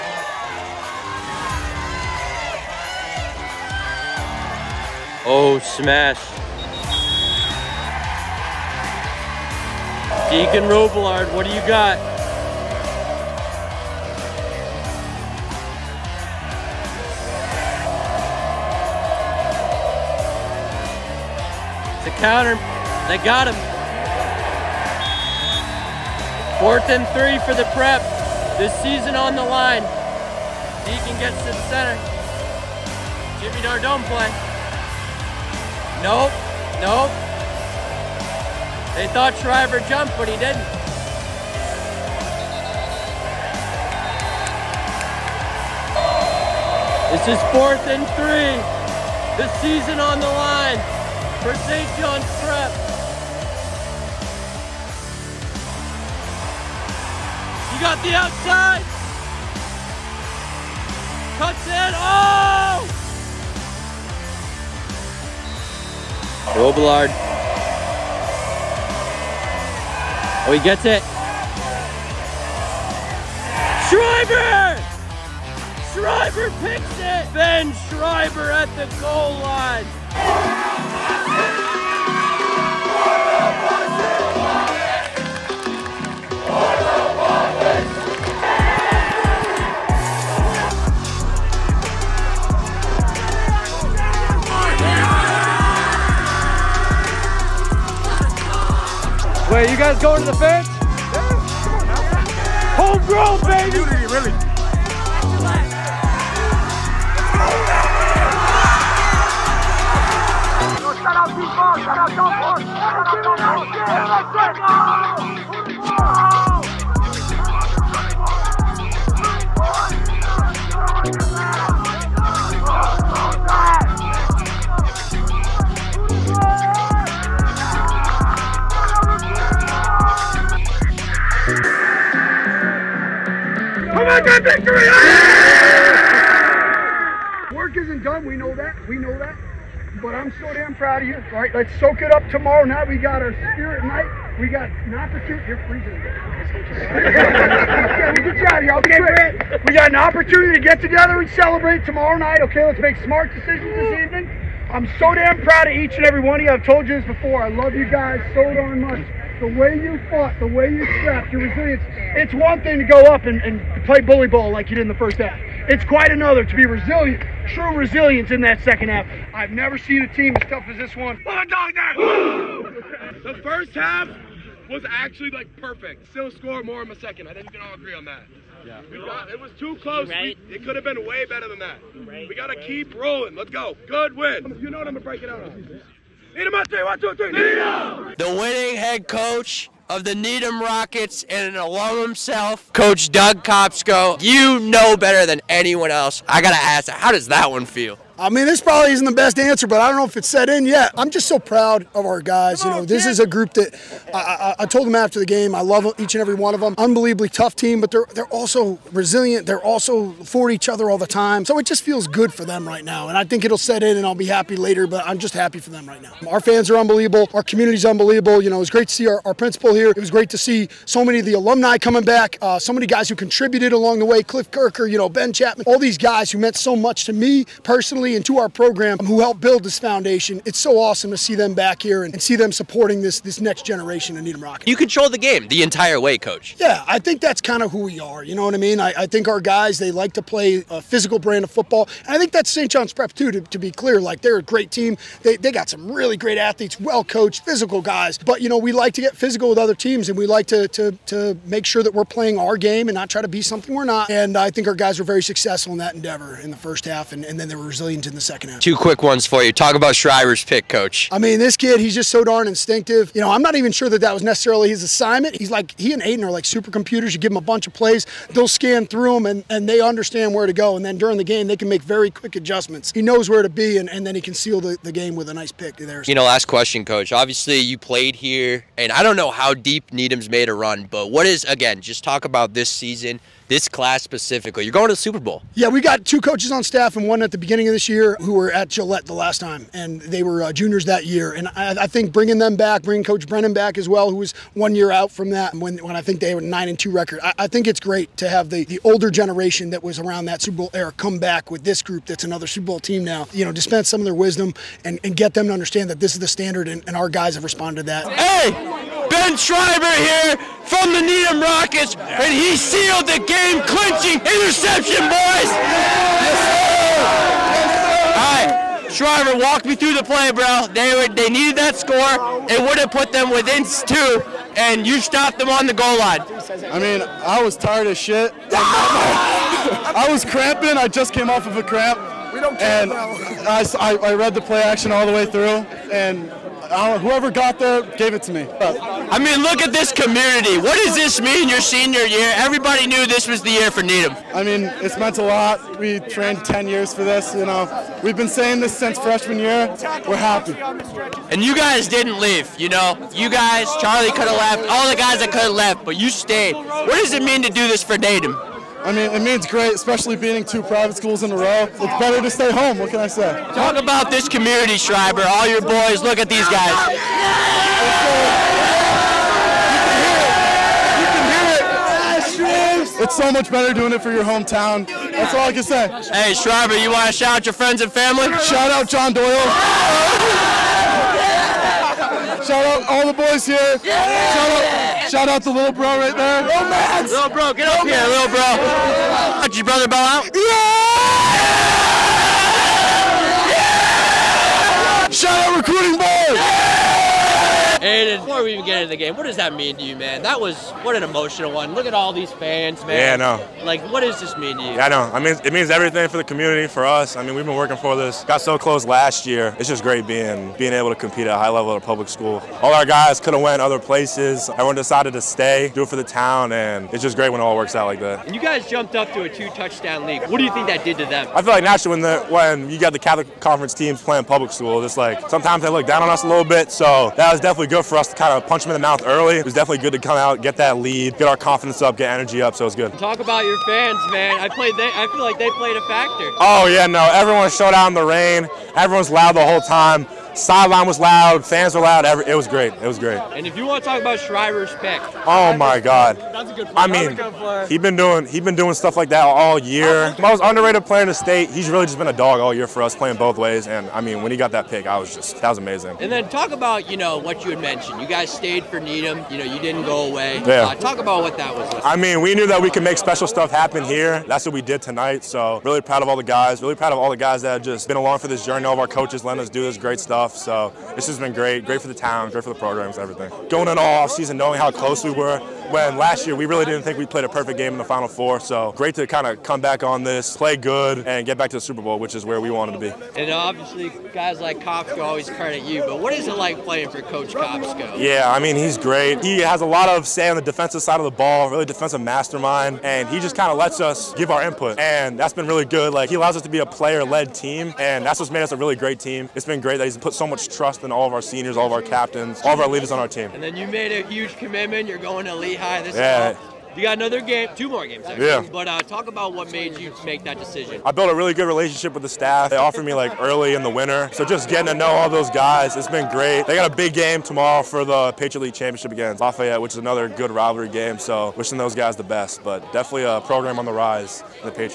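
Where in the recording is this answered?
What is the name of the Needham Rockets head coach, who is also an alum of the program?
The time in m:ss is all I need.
3:12.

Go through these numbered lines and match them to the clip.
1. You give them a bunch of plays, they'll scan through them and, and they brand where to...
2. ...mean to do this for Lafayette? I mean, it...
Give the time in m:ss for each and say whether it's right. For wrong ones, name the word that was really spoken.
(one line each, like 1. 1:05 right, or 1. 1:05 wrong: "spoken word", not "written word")
1. 4:27 wrong: "understand", not "brand"
2. 5:57 wrong: "Needham", not "Lafayette".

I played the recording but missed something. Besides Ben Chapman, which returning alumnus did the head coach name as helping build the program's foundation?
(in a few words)
Cliff Kirker.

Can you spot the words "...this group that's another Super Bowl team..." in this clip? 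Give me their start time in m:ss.
5:01.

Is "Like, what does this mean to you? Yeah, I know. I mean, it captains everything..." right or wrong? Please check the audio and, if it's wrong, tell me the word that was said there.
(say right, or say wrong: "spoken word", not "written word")
wrong: "means", not "captains".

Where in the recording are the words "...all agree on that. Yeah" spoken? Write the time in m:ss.
2:57.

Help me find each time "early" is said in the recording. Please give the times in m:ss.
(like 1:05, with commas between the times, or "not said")
7:09, 8:33.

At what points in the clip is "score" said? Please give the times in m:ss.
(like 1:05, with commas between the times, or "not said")
2:56, 5:21.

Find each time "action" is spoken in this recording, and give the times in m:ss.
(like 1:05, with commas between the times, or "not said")
5:34.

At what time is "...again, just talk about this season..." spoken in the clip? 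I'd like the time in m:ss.
4:41.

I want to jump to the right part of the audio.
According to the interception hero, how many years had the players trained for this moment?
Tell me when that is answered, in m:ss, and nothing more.
5:46.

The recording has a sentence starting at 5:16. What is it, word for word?
Yes, All right, Schreiber, walk me through the play, bro.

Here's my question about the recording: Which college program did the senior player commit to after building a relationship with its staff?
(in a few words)
Lehigh.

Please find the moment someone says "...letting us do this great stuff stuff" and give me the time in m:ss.
7:49.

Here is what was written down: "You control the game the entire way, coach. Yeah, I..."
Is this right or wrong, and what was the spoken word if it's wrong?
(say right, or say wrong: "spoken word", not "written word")
right.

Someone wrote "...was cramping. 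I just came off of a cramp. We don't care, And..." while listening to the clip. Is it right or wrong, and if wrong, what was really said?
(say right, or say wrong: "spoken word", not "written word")
right.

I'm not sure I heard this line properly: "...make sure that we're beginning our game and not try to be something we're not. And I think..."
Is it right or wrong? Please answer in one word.
wrong.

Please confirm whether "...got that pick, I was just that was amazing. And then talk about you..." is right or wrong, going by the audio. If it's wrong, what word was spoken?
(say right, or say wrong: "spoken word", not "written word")
right.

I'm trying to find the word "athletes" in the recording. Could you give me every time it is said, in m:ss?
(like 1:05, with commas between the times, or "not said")
4:06.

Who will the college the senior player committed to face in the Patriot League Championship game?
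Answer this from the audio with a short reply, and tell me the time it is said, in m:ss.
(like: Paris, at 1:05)
Lafayette, at 8:39.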